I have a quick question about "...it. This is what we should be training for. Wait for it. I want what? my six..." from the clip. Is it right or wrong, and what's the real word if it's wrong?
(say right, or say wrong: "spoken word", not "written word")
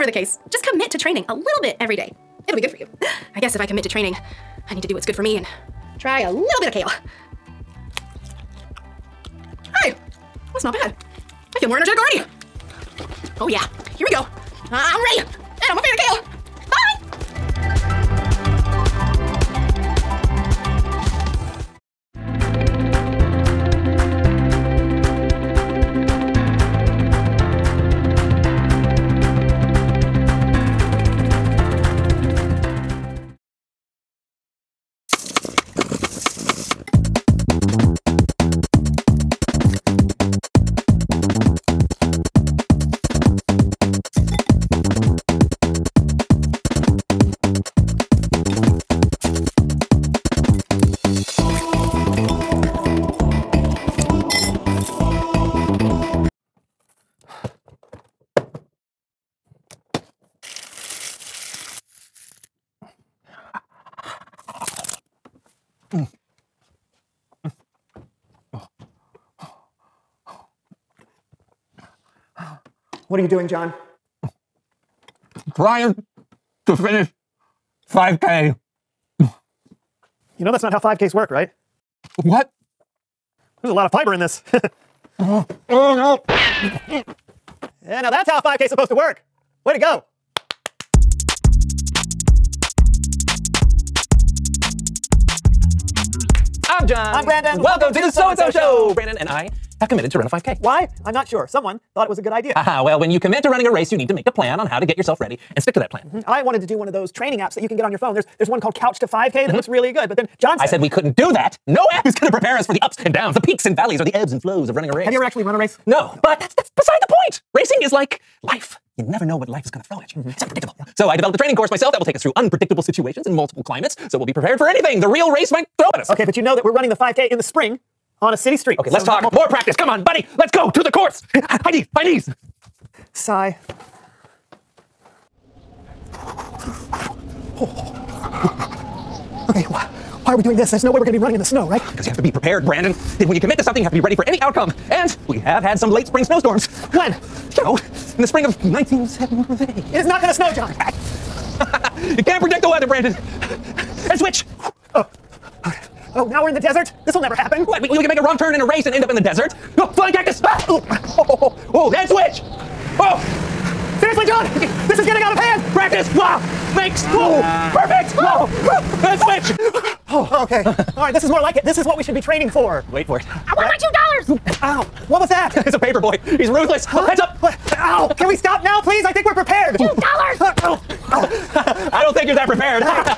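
wrong: "two", not "six".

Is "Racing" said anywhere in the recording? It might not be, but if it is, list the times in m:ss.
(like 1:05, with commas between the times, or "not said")
1:57.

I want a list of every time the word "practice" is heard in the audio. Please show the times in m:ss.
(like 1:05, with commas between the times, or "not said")
2:09, 2:45.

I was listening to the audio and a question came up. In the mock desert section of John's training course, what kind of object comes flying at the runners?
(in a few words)
cactus.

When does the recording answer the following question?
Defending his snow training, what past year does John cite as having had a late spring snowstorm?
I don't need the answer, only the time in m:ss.
2:28.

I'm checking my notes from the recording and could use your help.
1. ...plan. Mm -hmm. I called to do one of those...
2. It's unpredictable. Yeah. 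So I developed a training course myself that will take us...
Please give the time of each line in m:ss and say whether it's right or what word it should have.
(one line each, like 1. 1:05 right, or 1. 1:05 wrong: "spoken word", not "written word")
1. 1:45 wrong: "wanted", not "called"
2. 2:00 right.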